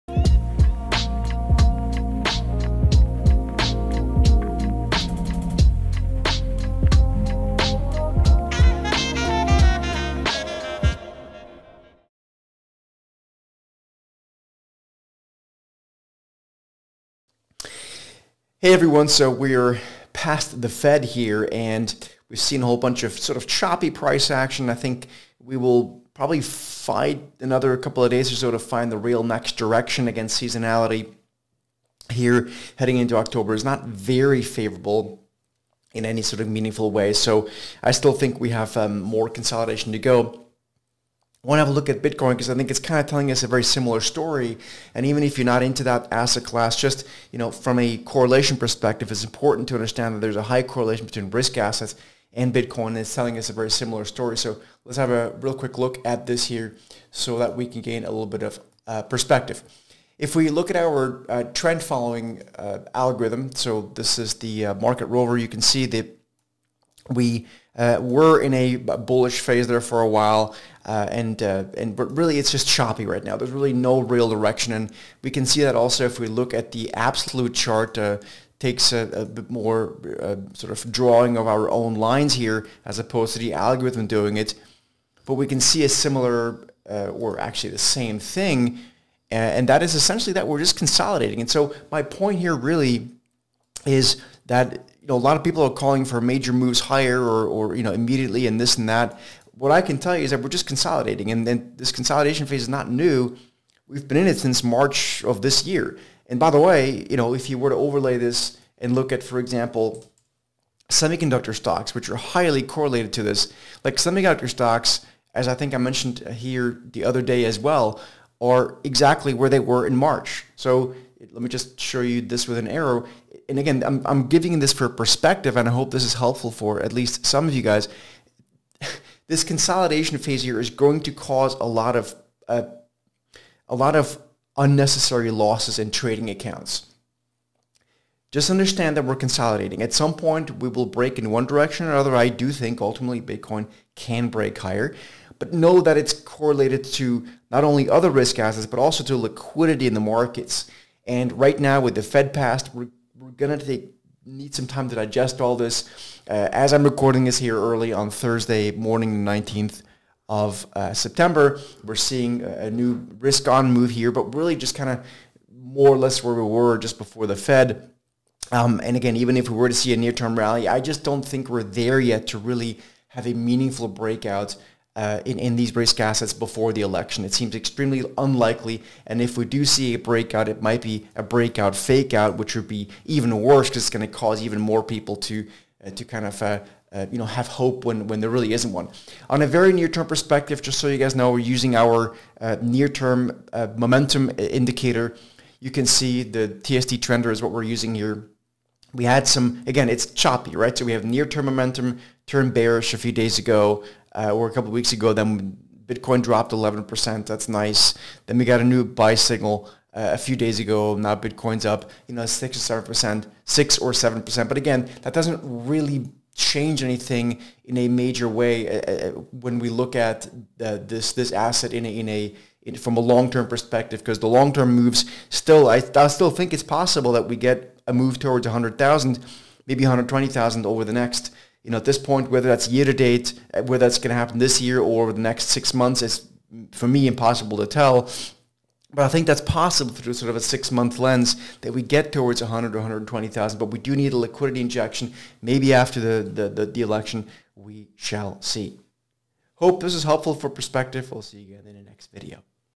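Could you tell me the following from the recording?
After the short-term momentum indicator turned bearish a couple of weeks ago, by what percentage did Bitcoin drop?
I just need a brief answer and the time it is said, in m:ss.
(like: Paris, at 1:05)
11%, at 3:26.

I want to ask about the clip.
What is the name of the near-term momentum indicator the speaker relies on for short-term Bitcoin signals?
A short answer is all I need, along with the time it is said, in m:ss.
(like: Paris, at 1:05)
TSD trender, at 3:16.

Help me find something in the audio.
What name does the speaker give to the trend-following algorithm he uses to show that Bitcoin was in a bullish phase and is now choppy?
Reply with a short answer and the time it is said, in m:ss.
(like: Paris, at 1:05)
Market Rover, at 1:04.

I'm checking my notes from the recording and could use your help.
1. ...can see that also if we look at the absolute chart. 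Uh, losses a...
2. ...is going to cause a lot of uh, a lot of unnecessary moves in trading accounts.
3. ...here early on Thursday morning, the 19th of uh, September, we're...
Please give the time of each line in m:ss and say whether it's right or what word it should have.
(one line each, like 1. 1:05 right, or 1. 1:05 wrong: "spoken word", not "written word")
1. 1:15 wrong: "takes", not "losses"
2. 2:10 wrong: "losses", not "moves"
3. 2:37 right.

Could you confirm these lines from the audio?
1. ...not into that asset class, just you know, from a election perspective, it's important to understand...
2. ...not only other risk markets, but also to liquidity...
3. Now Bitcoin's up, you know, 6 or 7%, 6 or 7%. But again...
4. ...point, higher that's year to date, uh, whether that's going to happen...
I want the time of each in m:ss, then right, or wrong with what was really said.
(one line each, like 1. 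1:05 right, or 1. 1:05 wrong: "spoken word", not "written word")
1. 0:45 wrong: "correlation", not "election"
2. 2:27 wrong: "assets", not "markets"
3. 3:30 right
4. 3:51 wrong: "whether", not "higher".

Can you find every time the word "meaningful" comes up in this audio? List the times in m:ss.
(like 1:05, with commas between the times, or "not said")
0:36, 2:53.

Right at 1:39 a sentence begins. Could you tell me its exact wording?
What I can tell you is that we're just consolidating, and then this consolidation phase is not new.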